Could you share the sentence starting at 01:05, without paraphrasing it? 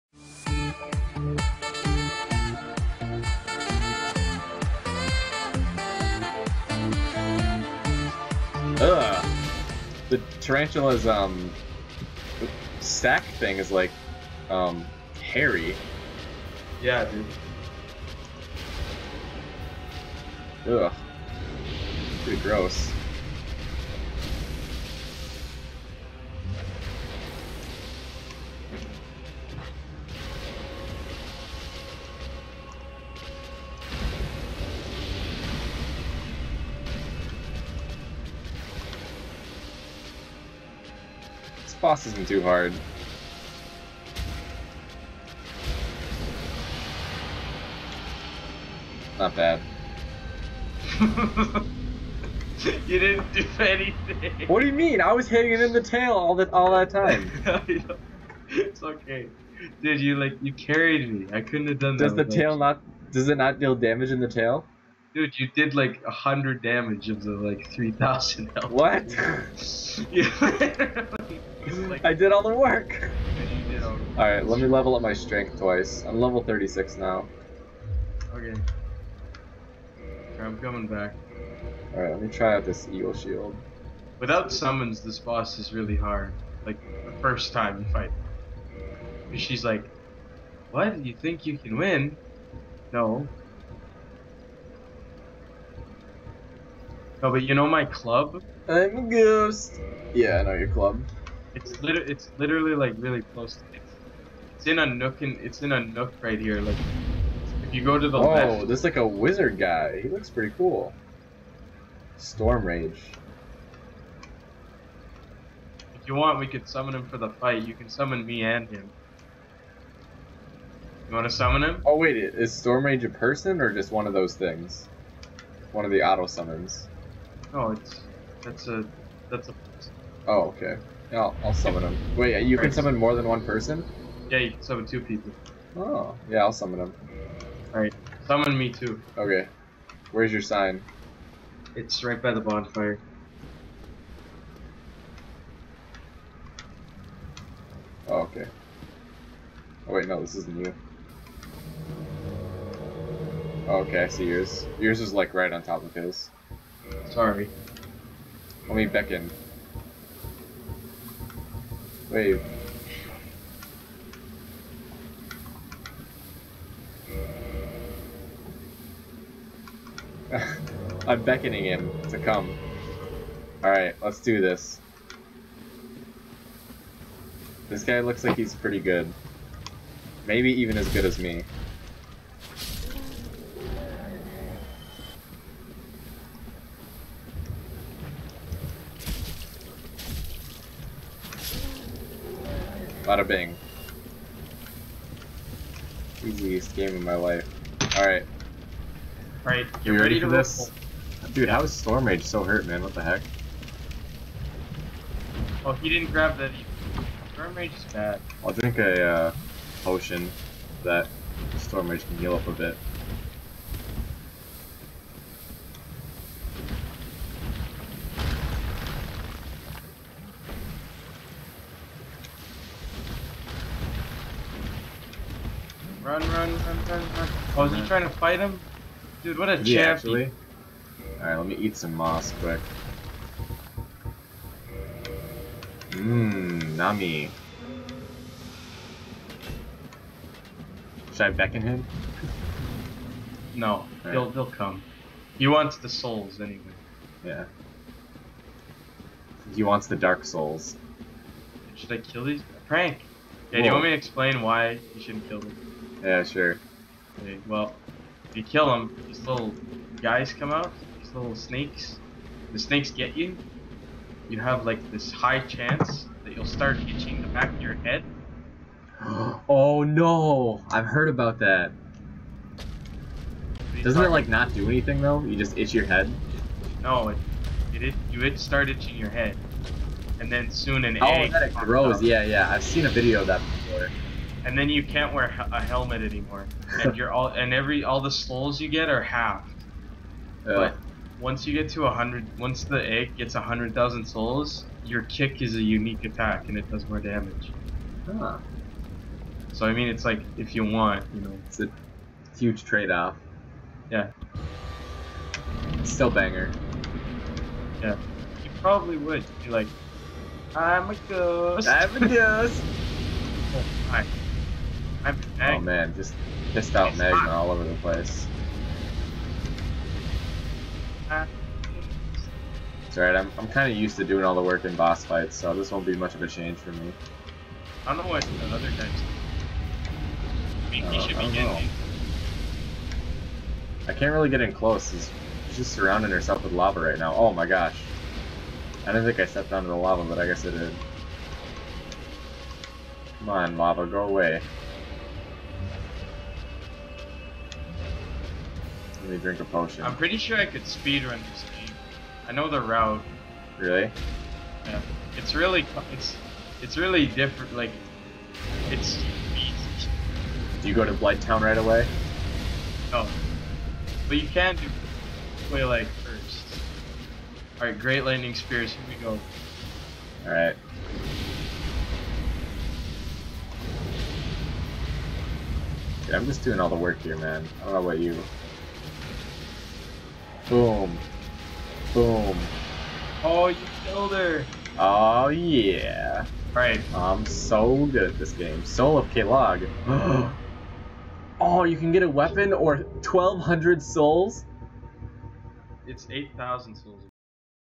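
Dude, you did like a hundred damage of the like three thousand.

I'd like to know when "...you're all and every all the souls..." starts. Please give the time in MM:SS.
04:46.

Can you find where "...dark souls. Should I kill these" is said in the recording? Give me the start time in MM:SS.
04:09.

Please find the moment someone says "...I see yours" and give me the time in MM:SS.
02:34.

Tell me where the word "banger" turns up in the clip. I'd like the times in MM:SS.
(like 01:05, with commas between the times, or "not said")
05:06.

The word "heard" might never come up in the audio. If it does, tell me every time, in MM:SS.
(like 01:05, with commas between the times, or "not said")
04:30.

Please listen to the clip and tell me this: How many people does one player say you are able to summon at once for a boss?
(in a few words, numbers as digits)
2.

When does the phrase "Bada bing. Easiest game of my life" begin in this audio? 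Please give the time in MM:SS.
03:13.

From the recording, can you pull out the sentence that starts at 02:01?
Oh wait, is storm rage a person or just one of those things?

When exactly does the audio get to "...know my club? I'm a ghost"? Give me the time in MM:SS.
01:37.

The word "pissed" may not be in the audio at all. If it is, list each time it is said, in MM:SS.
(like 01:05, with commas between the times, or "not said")
05:16.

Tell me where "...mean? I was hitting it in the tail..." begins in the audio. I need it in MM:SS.
00:54.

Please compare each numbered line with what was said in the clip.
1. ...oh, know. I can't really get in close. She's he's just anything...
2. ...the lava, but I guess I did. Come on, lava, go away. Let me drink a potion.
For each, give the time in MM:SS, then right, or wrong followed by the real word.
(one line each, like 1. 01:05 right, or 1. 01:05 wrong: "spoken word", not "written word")
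1. 05:31 wrong: "surrounding", not "anything"
2. 05:39 right.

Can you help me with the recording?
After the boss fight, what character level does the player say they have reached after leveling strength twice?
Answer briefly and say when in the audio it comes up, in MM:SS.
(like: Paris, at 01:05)
36, at 01:16.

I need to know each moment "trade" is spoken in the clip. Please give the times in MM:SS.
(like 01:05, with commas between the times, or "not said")
05:02.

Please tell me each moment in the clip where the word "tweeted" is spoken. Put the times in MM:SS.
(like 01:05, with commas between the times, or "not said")
not said.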